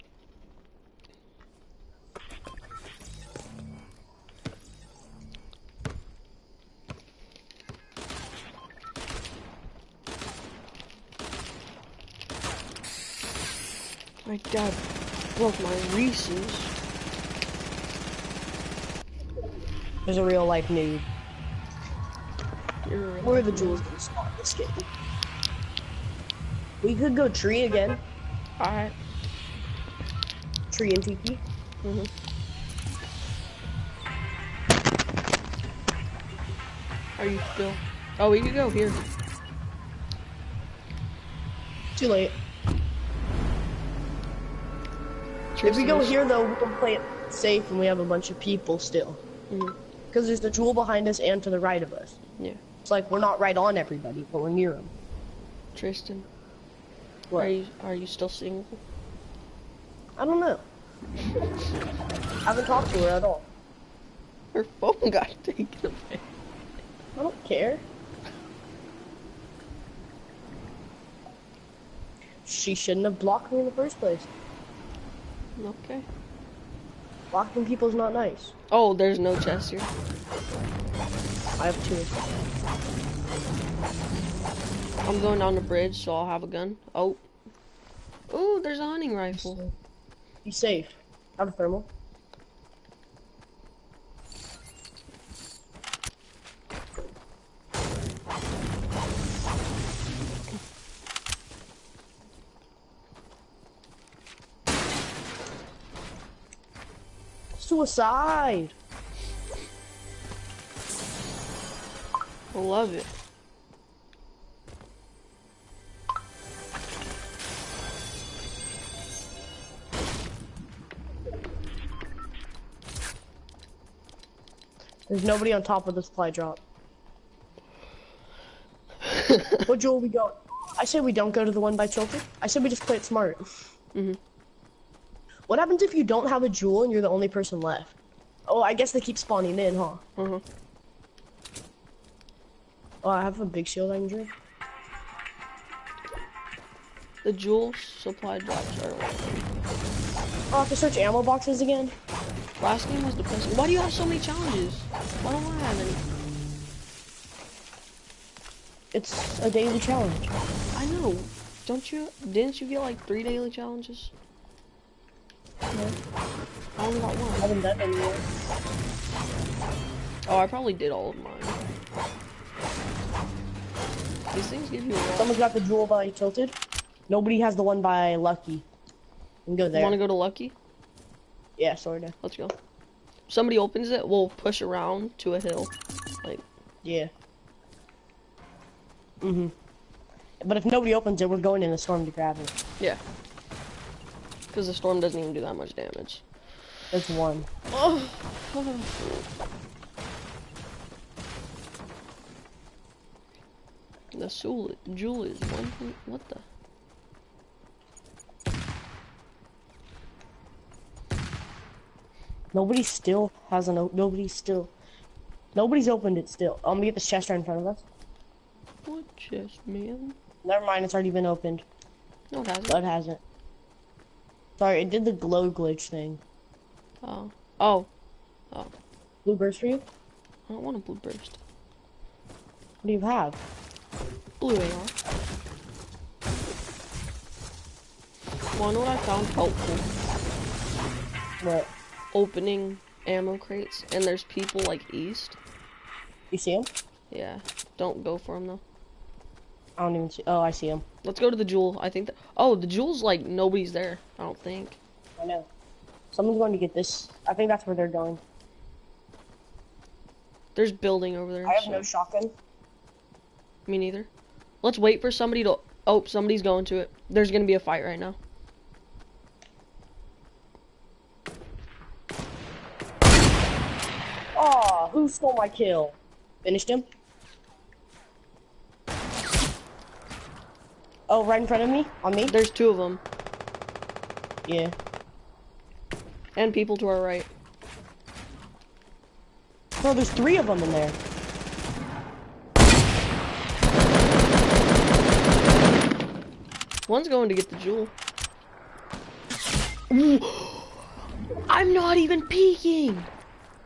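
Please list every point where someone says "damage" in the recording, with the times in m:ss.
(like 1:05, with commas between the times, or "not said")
3:15.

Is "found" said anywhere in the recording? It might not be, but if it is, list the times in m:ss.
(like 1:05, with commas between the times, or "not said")
3:58.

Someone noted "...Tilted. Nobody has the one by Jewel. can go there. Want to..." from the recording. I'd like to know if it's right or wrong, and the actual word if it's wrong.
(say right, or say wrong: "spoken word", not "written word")
wrong: "Lucky", not "Jewel".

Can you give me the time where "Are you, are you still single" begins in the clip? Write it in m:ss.
0:57.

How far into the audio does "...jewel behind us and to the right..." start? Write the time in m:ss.
0:50.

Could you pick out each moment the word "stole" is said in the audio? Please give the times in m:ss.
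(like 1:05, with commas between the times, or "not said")
4:35.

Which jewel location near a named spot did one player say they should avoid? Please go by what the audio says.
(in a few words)
Chilton.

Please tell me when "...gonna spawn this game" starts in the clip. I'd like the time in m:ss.
0:23.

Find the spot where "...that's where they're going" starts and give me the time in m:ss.
4:17.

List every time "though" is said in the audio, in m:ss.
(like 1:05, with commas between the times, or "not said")
0:46, 4:08.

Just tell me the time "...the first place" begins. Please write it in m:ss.
1:13.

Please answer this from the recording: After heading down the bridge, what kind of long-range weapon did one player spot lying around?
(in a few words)
Hunting rifle.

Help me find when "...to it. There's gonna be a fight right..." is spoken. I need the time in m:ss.
4:26.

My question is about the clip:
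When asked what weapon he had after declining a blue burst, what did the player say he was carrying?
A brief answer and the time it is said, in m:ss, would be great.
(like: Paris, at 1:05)
Blue AR, at 3:54.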